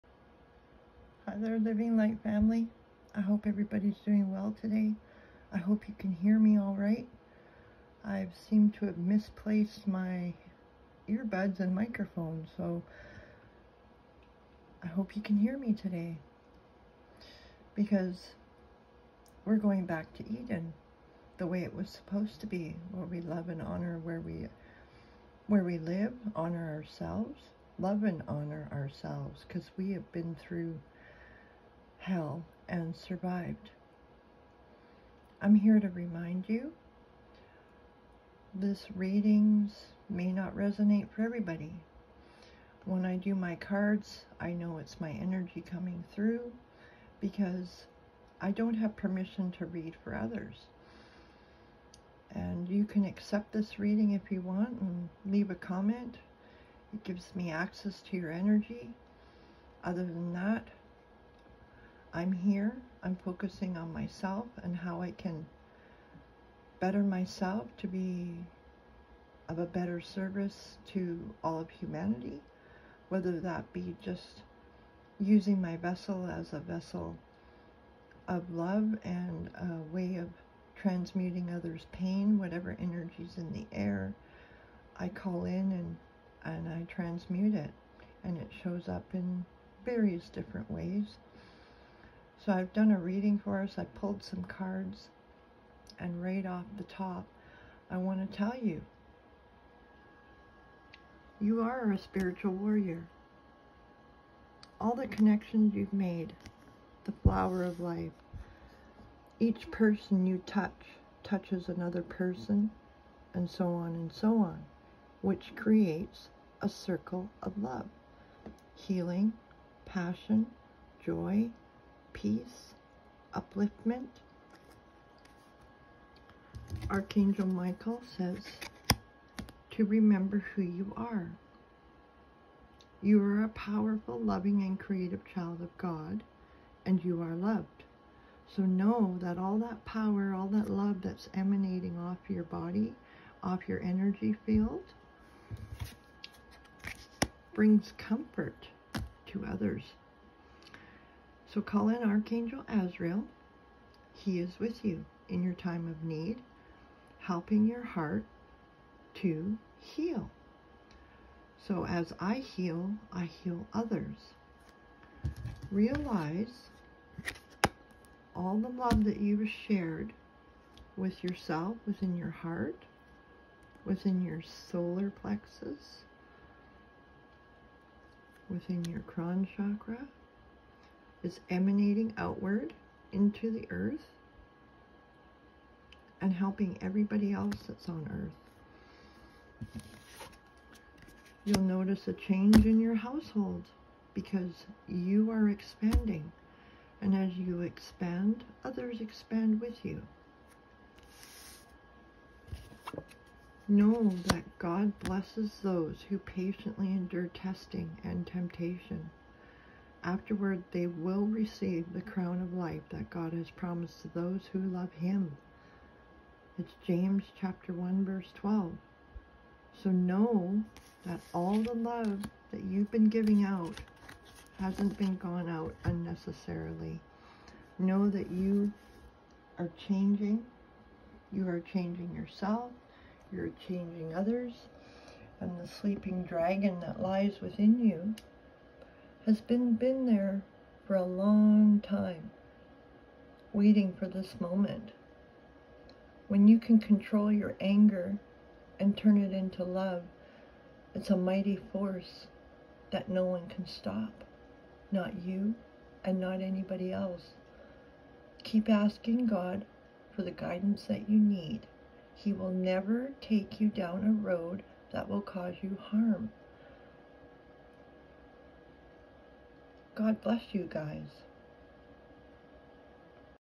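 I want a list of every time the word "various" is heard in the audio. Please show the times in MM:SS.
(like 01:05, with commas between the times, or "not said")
01:29.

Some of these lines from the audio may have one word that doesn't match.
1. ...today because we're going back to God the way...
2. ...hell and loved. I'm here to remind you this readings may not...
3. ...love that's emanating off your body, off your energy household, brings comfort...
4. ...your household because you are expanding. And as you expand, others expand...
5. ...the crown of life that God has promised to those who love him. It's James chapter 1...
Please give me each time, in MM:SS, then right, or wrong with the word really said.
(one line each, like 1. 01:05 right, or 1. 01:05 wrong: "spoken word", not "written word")
1. 00:15 wrong: "Eden", not "God"
2. 00:32 wrong: "survived", not "loved"
3. 02:20 wrong: "field", not "household"
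4. 03:12 right
5. 03:31 right.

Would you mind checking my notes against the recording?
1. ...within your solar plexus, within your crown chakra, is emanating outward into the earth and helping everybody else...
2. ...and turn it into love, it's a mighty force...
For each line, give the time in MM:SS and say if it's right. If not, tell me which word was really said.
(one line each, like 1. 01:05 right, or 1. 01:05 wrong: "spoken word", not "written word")
1. 02:53 right
2. 04:08 right.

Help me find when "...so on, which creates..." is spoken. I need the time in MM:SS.
01:54.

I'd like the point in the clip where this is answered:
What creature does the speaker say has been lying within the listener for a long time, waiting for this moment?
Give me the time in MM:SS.
03:55.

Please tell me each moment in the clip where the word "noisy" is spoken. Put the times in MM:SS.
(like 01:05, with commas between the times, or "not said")
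not said.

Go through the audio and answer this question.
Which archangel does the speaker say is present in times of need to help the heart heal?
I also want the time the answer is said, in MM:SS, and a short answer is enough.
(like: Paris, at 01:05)
Archangel Azrael, at 02:32.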